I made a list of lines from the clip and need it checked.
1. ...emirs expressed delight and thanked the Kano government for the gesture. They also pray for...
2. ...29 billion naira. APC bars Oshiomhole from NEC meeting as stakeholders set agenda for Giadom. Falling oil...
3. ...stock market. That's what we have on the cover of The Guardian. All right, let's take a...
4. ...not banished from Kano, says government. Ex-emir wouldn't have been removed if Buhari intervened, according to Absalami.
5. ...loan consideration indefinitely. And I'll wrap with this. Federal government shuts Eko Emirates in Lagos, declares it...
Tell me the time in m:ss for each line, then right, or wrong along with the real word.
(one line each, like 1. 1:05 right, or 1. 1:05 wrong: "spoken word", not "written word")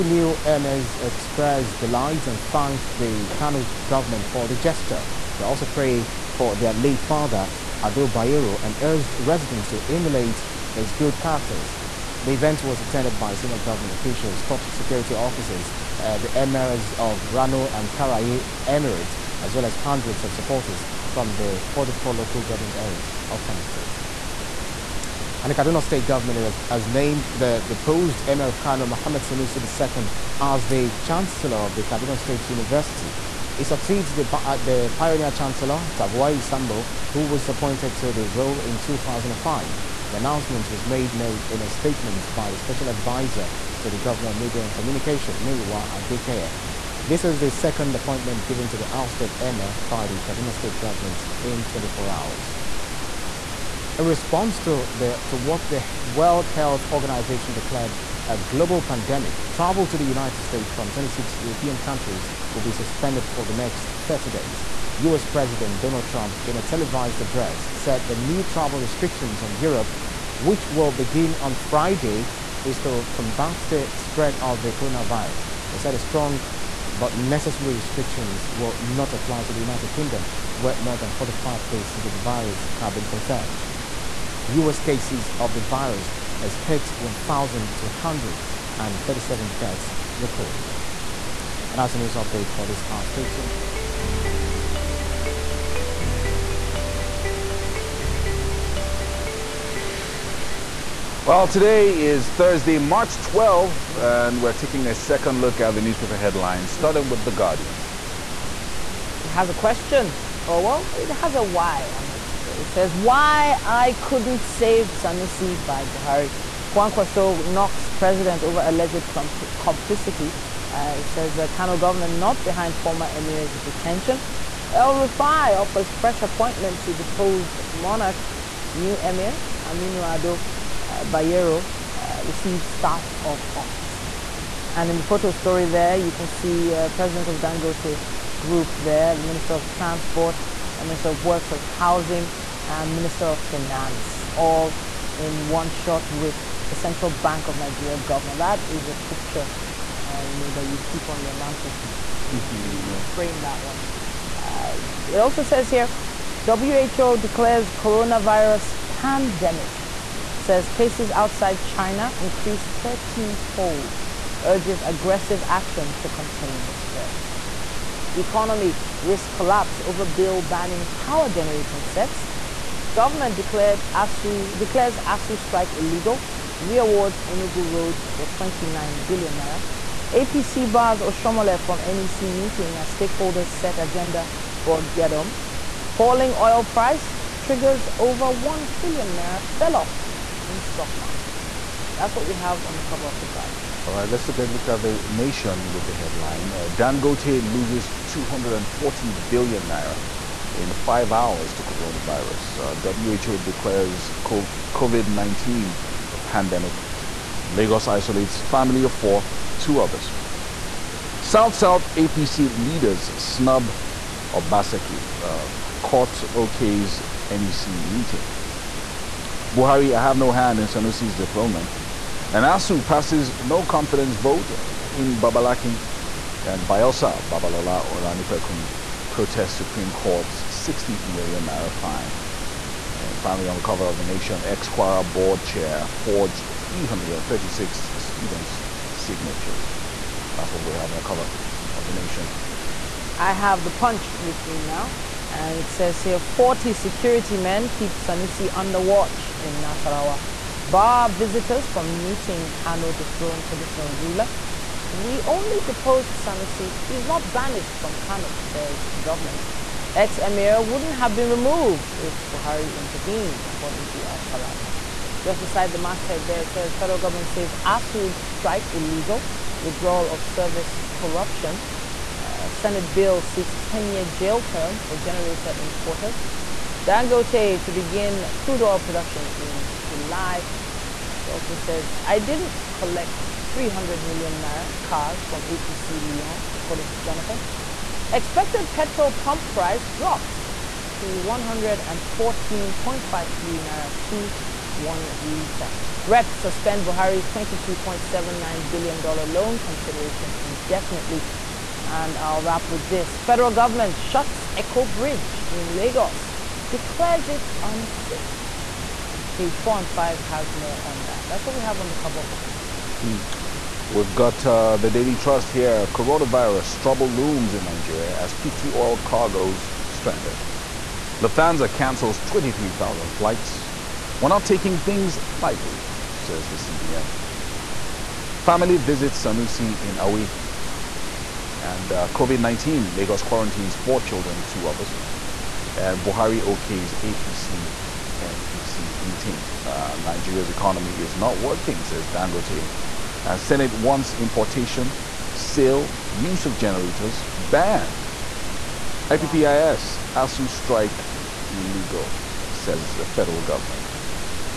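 1. 0:00 right
2. 2:58 right
3. 3:10 right
4. 4:17 right
5. 4:59 wrong: "Bridge", not "Emirates".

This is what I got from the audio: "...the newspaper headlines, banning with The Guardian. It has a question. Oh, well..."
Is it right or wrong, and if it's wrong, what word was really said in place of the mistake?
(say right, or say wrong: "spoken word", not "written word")
wrong: "starting", not "banning".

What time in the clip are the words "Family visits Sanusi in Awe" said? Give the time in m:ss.
5:28.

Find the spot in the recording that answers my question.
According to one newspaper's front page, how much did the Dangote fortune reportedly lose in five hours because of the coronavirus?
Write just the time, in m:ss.
3:18.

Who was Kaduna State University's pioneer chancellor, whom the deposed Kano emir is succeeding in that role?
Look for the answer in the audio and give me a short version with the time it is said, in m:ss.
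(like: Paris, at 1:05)
Tagwai Sambo, at 0:35.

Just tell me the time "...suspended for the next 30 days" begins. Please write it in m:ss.
1:02.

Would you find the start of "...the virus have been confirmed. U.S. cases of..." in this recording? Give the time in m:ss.
1:22.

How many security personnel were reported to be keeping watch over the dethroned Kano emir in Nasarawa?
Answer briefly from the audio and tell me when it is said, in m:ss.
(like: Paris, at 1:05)
40, at 4:06.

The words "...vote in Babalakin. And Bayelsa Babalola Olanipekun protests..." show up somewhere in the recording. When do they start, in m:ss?
3:44.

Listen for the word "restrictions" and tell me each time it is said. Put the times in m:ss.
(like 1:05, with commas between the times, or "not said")
1:08, 1:17.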